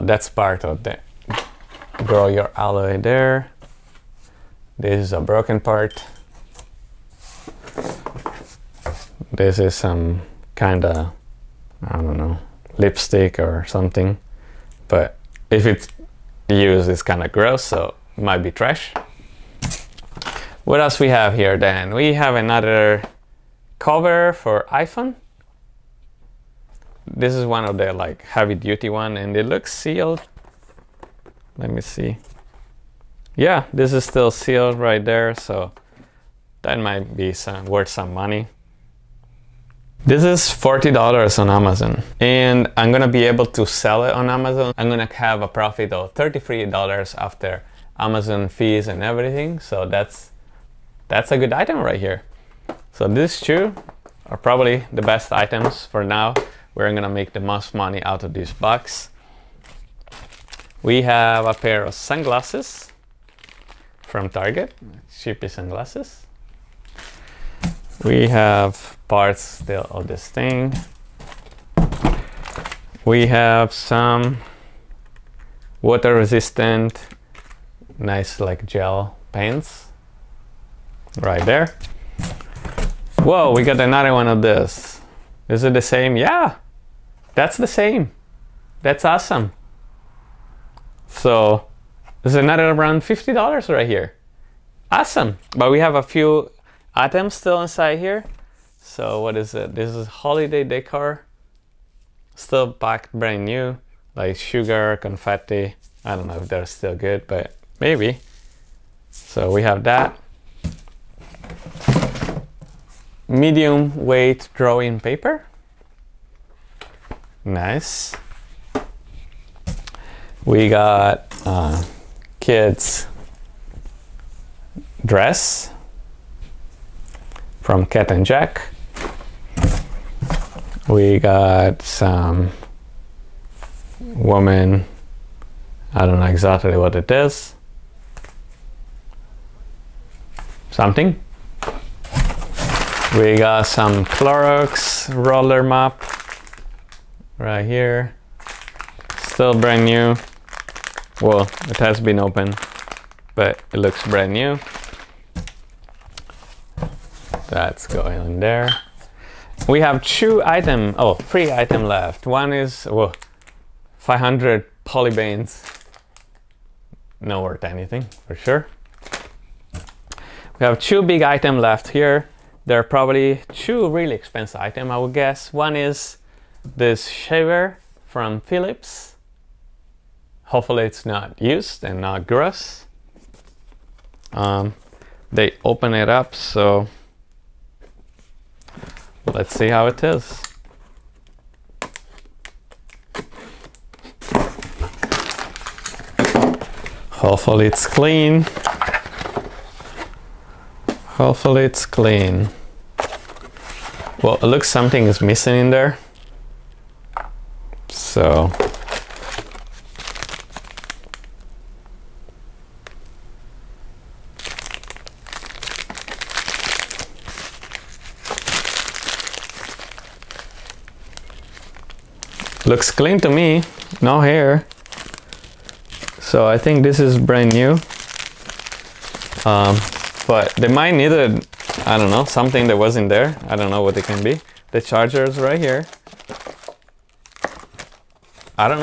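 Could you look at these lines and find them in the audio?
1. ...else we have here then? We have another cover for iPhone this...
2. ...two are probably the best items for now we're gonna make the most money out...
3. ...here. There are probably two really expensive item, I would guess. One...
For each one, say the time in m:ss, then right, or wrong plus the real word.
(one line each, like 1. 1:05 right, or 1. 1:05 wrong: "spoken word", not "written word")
1. 0:20 right
2. 0:53 right
3. 2:51 right.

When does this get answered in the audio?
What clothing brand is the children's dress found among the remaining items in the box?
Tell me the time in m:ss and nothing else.
2:07.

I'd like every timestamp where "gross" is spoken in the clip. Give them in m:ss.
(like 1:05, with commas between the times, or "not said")
0:17, 3:02.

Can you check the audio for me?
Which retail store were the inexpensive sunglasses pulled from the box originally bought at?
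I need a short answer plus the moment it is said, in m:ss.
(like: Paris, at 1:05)
Target, at 1:04.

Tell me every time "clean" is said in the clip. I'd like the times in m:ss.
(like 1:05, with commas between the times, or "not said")
3:17, 3:21, 3:42.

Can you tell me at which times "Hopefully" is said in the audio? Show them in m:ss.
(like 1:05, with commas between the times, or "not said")
3:00, 3:17, 3:21.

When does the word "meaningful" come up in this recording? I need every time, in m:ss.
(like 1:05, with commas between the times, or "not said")
not said.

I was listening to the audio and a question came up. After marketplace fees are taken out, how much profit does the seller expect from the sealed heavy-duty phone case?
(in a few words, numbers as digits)
$33.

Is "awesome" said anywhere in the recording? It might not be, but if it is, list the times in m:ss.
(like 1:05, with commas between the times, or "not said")
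1:29, 1:34.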